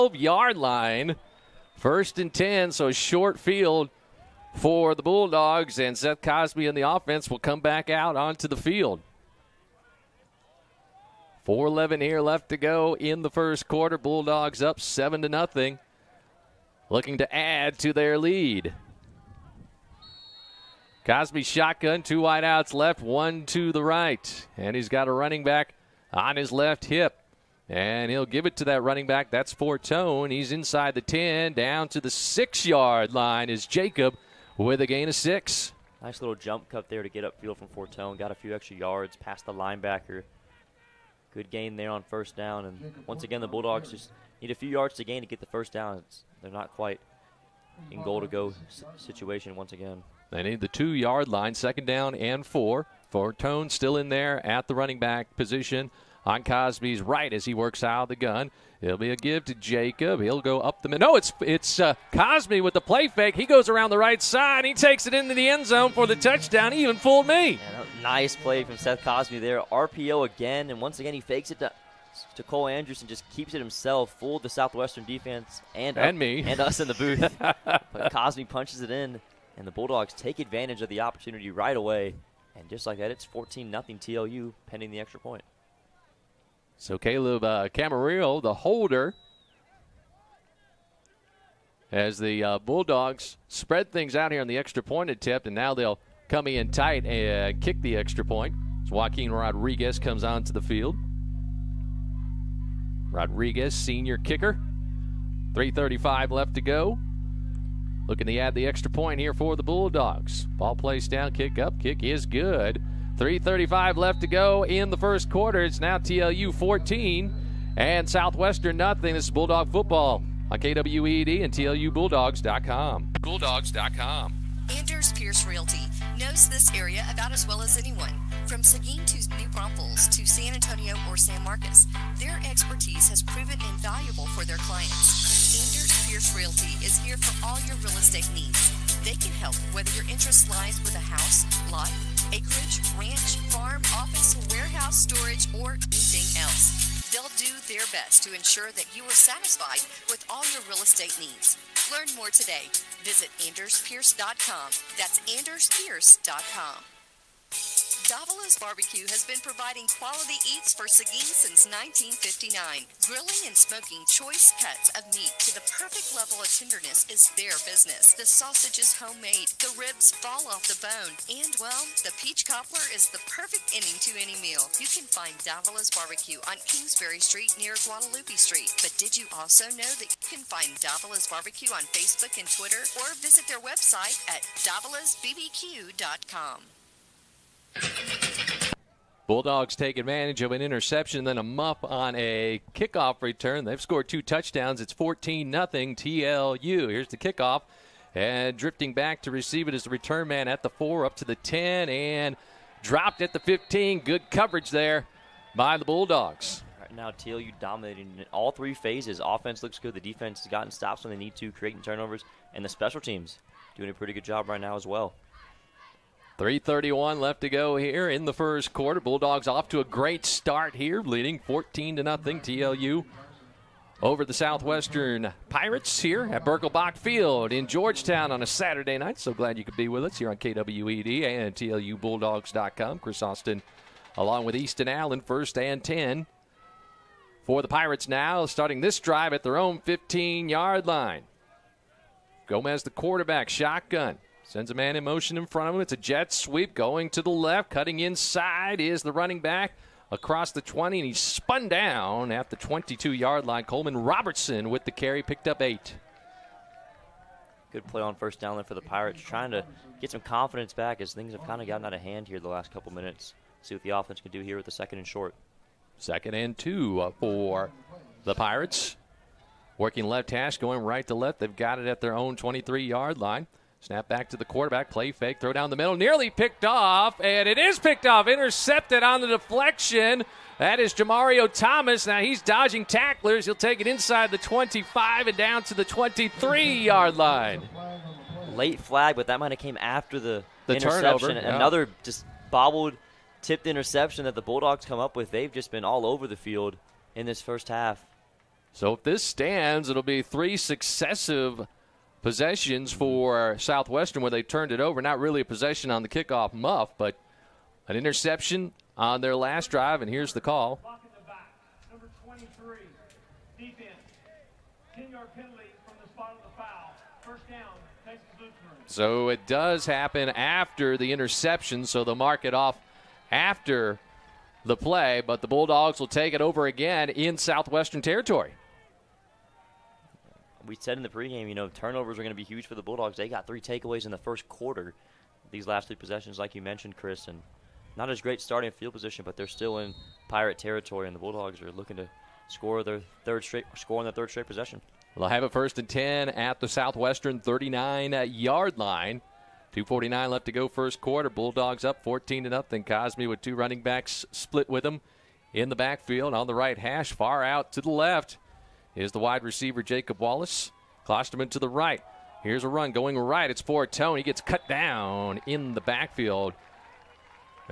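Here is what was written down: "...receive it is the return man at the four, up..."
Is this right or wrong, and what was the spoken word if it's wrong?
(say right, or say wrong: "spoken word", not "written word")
right.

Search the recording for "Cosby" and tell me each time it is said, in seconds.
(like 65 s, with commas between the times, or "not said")
6 s, 21 s, 56 s.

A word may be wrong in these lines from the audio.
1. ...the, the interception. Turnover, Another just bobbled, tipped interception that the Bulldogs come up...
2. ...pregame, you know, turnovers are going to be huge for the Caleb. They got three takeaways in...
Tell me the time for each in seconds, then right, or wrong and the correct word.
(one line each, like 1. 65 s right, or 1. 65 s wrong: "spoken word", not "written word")
1. 290 s right
2. 331 s wrong: "Bulldogs", not "Caleb".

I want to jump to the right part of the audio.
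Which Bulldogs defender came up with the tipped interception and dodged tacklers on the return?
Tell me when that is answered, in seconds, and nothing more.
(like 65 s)
280 s.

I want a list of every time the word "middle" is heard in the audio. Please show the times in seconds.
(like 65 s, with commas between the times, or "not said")
60 s, 275 s.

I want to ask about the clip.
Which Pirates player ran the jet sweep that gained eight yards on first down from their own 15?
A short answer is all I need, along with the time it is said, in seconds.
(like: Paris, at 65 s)
Coleman Robertson, at 253 s.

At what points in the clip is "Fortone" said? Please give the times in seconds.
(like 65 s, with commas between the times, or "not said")
29 s, 37 s, 53 s, 363 s.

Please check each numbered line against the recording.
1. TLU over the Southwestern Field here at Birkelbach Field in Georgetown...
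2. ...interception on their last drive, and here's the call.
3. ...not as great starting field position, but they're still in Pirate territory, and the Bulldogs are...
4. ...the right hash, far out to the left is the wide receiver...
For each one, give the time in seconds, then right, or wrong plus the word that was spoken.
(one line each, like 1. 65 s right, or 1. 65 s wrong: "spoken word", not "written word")
1. 222 s wrong: "Pirates", not "Field"
2. 307 s right
3. 337 s right
4. 356 s right.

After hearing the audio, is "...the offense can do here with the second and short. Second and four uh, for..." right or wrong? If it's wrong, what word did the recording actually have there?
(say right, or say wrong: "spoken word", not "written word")
wrong: "two", not "four".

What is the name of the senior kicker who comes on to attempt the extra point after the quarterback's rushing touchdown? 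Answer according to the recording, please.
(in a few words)
Joaquin Rodriguez.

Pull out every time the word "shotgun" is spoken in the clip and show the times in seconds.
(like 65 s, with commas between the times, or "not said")
21 s, 243 s.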